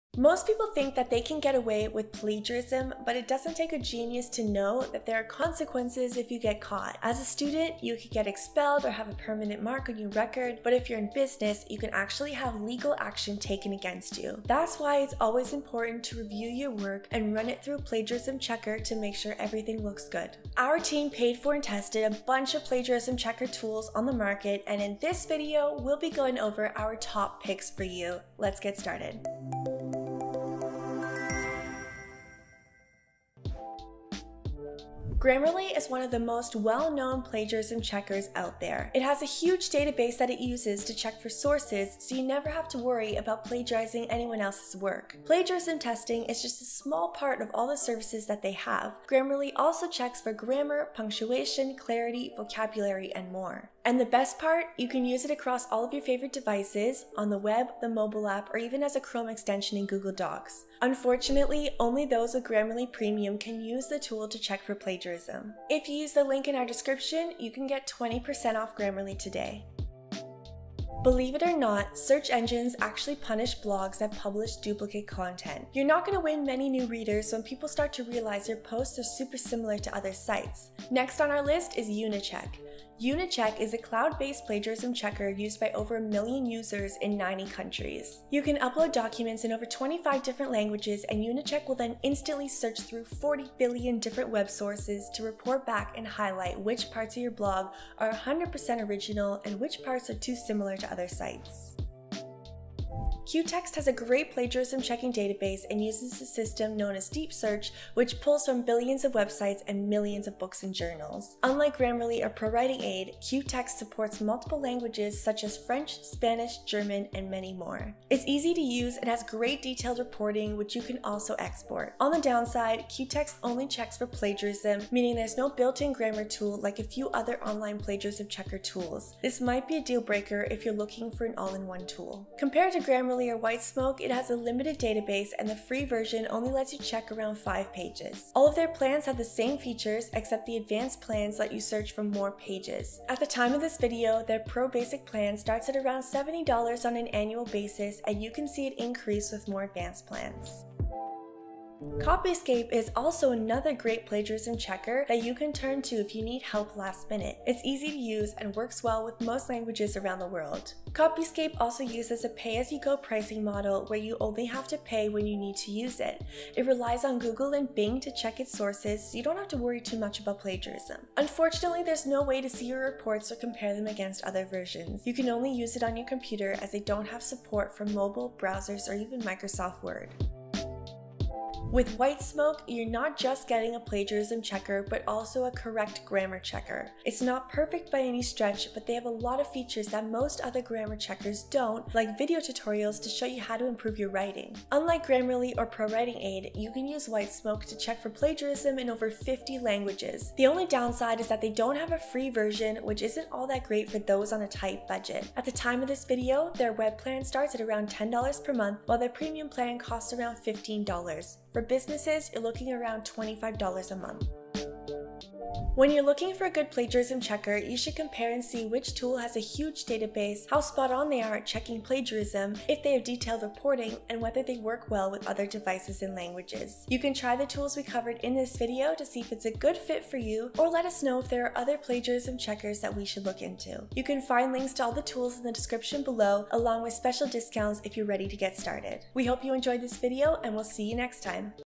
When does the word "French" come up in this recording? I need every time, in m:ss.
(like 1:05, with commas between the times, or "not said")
1:55.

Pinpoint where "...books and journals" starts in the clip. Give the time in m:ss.
1:50.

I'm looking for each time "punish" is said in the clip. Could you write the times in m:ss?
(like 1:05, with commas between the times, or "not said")
1:13.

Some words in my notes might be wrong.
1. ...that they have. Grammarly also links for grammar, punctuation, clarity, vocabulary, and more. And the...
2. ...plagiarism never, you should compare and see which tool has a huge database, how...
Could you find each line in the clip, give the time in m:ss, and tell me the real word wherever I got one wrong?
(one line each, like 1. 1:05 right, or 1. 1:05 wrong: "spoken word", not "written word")
1. 0:48 wrong: "checks", not "links"
2. 3:36 wrong: "checker", not "never".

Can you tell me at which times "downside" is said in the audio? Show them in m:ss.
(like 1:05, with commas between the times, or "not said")
2:02, 3:20.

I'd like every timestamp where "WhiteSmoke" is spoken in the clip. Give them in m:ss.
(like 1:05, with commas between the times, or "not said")
2:13, 3:01, 3:17.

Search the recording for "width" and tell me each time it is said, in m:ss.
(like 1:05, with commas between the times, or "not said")
not said.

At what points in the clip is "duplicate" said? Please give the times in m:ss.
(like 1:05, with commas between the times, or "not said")
1:14.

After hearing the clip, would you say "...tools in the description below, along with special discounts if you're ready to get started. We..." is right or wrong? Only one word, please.
right.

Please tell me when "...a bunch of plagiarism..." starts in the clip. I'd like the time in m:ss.
0:22.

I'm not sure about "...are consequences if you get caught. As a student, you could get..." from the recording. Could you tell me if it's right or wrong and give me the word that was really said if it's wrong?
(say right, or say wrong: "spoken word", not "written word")
right.